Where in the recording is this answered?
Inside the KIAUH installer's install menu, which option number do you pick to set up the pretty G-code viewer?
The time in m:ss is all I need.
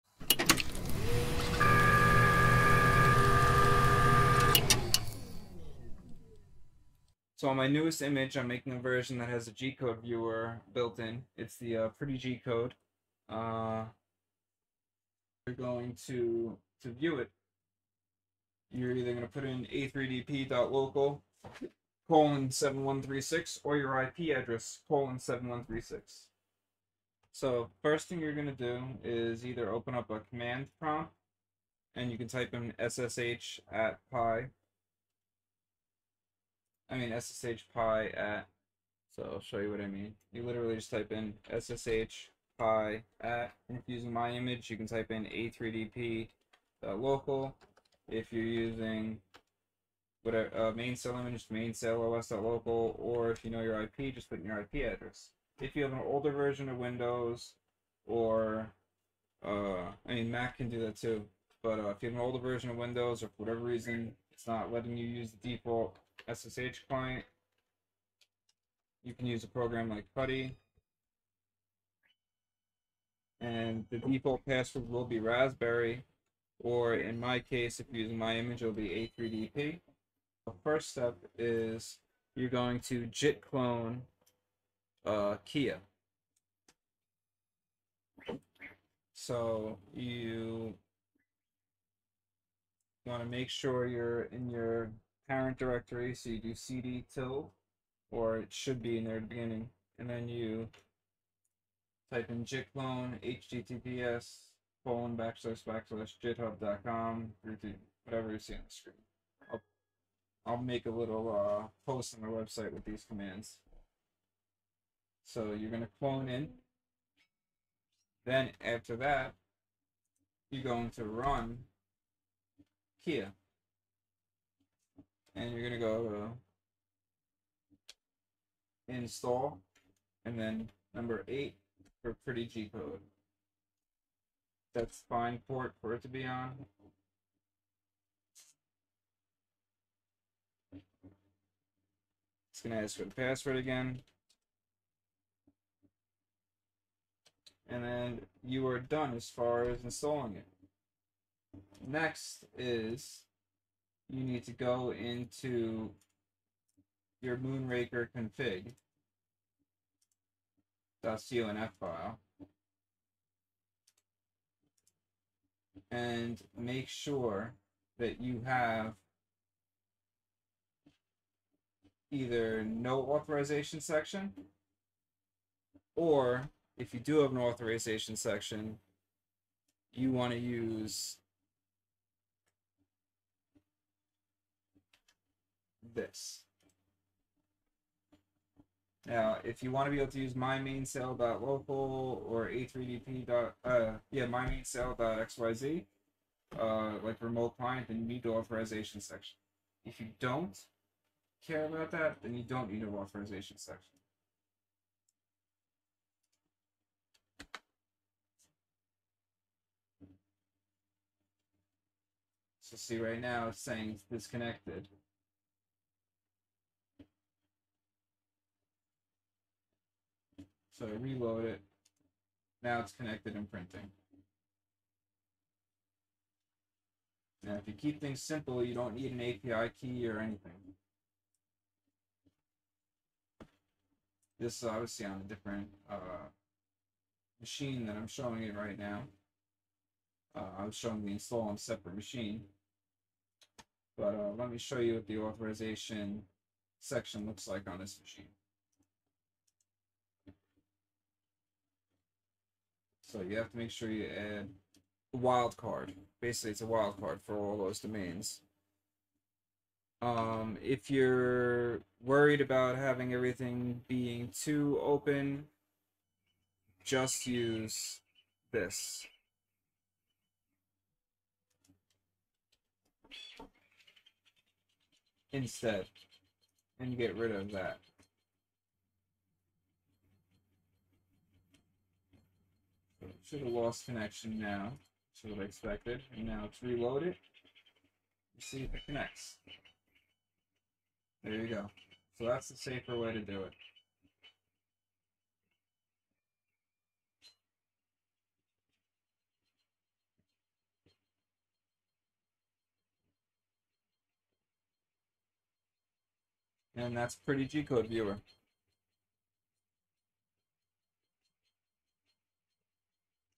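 2:10.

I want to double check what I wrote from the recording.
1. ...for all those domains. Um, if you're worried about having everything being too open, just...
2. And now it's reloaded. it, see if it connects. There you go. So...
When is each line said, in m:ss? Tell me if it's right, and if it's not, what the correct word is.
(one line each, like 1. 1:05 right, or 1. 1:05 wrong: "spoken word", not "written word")
1. 4:17 right
2. 4:46 right.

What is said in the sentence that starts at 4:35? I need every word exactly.
Instead, and get rid of that.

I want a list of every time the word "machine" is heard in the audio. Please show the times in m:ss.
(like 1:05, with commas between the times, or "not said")
3:57, 4:01, 4:08.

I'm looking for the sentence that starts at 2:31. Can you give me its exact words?
Next is you need to go into your Moonraker config.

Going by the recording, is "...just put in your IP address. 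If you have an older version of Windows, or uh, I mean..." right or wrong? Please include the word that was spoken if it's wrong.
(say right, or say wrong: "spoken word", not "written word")
right.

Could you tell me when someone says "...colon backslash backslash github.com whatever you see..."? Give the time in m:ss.
1:44.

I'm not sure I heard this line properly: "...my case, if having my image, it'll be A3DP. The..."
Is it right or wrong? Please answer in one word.
wrong.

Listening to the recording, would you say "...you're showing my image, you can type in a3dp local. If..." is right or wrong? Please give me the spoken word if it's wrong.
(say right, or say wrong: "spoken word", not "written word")
wrong: "using", not "showing".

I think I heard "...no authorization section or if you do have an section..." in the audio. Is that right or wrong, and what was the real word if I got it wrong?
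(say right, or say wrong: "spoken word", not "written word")
wrong: "authorization", not "section".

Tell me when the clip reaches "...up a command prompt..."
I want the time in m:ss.
0:29.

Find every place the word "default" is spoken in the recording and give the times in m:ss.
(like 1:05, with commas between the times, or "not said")
1:05, 1:13.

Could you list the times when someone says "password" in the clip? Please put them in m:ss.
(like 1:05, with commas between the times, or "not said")
1:14, 2:23.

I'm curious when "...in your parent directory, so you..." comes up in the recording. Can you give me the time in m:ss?
1:34.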